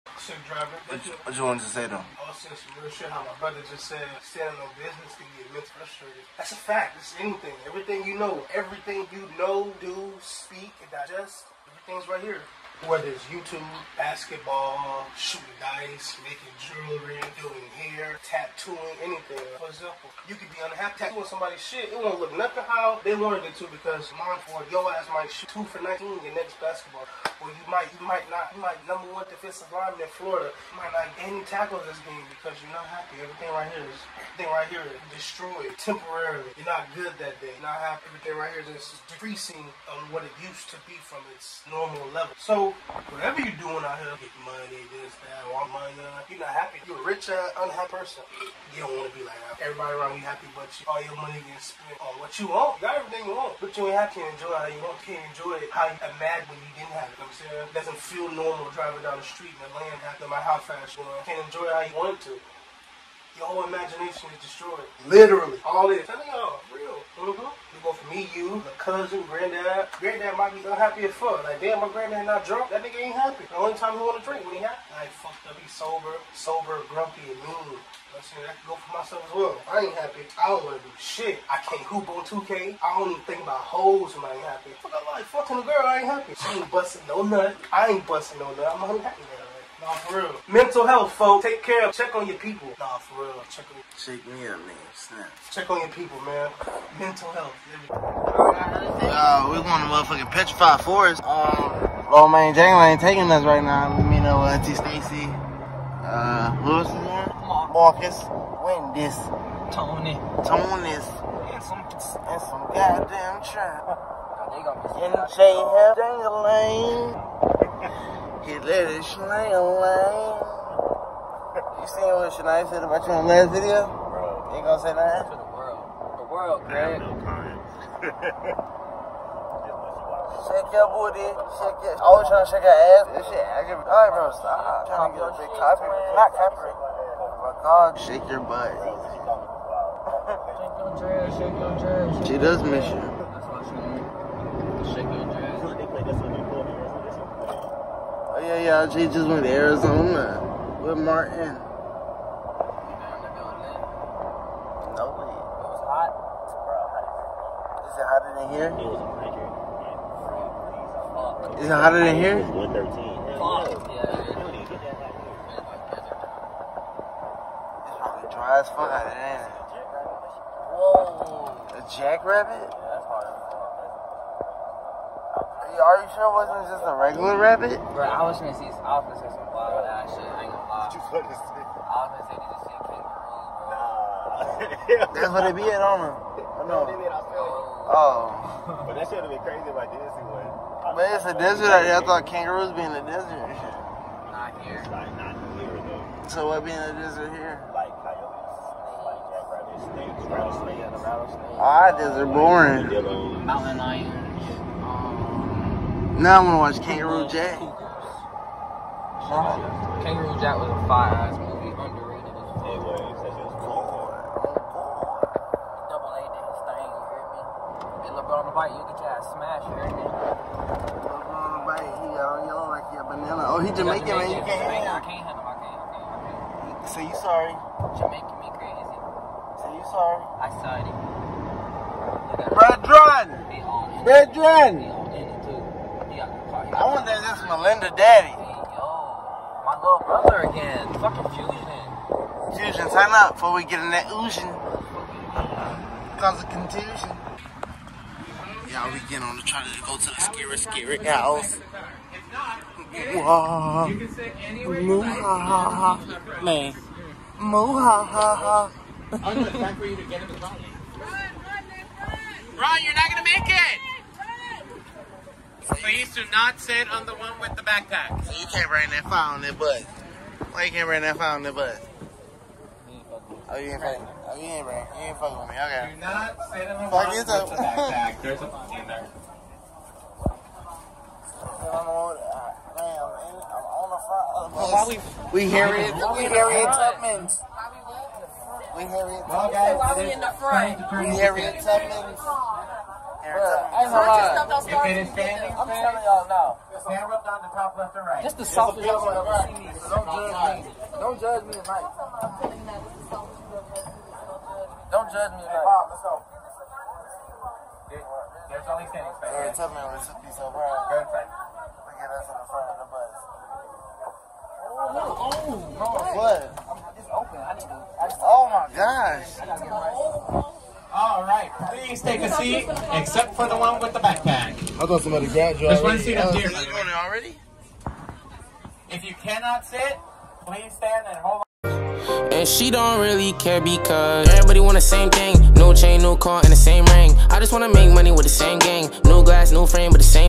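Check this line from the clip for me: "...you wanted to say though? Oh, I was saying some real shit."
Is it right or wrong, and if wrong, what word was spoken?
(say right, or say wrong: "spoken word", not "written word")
right.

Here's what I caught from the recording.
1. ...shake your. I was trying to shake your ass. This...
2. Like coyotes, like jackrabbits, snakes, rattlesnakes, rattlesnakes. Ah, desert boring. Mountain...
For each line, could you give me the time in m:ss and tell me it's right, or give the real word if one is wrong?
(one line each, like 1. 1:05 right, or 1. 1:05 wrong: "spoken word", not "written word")
1. 2:11 right
2. 3:17 right.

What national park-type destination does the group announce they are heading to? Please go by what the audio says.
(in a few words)
Petrified Forest.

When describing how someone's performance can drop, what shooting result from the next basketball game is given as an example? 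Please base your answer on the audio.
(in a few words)
2 for 19.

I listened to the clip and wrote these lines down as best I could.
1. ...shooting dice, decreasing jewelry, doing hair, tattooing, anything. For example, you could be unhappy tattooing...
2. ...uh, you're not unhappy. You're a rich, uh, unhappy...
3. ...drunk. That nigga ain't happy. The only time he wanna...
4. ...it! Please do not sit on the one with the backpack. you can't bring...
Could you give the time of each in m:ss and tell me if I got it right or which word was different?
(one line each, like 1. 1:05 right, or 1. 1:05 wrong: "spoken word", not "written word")
1. 0:15 wrong: "making", not "decreasing"
2. 0:46 wrong: "happy", not "unhappy"
3. 1:12 right
4. 4:23 right.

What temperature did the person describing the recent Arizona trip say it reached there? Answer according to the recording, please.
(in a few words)
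113.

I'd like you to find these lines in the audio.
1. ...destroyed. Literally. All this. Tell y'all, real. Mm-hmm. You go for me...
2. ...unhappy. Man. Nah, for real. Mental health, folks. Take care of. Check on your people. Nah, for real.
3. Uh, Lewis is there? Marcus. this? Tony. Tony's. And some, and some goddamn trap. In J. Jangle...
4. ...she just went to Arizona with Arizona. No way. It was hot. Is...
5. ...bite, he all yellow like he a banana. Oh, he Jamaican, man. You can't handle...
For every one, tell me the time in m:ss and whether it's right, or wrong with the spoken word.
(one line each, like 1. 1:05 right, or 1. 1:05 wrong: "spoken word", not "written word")
1. 1:04 right
2. 1:28 right
3. 1:46 right
4. 2:28 wrong: "Martin", not "Arizona"
5. 3:41 right.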